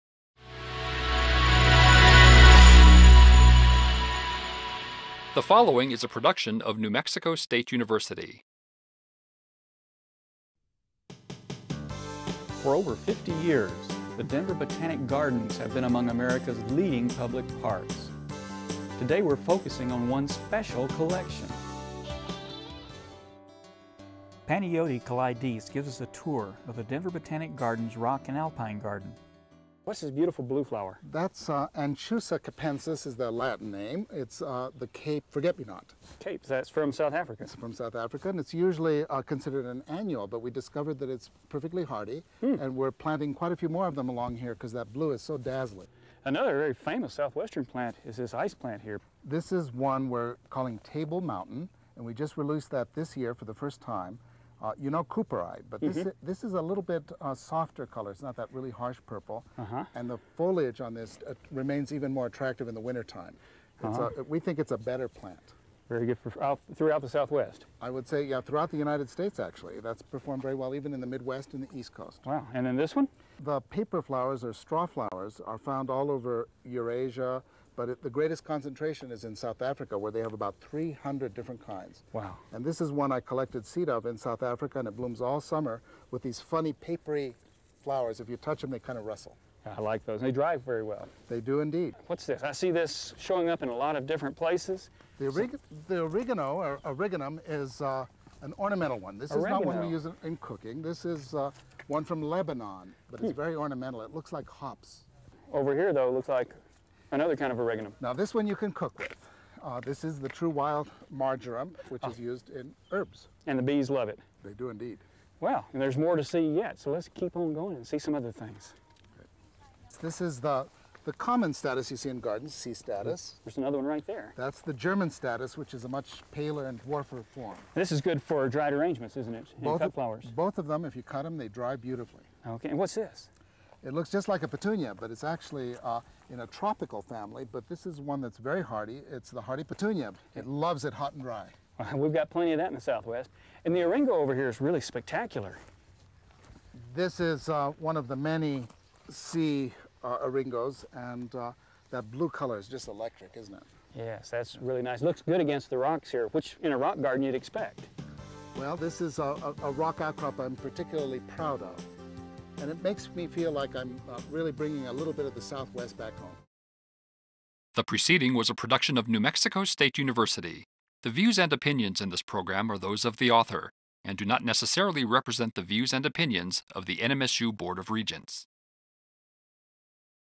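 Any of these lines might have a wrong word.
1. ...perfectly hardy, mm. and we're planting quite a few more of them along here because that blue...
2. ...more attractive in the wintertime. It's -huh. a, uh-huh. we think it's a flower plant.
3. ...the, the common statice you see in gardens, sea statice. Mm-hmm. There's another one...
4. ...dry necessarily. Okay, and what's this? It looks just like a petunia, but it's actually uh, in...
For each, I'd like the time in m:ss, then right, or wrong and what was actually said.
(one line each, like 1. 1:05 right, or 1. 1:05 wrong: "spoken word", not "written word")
1. 0:41 right
2. 1:02 wrong: "better", not "flower"
3. 2:00 right
4. 2:11 wrong: "beautifully", not "necessarily".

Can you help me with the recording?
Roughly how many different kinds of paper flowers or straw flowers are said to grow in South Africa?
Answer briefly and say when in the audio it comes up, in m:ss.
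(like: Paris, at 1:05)
300, at 1:20.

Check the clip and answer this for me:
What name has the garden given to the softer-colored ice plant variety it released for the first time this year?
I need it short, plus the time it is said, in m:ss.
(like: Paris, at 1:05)
Table Mountain, at 0:50.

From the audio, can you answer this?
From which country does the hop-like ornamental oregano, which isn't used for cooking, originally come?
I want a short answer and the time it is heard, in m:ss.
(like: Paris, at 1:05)
Lebanon, at 1:42.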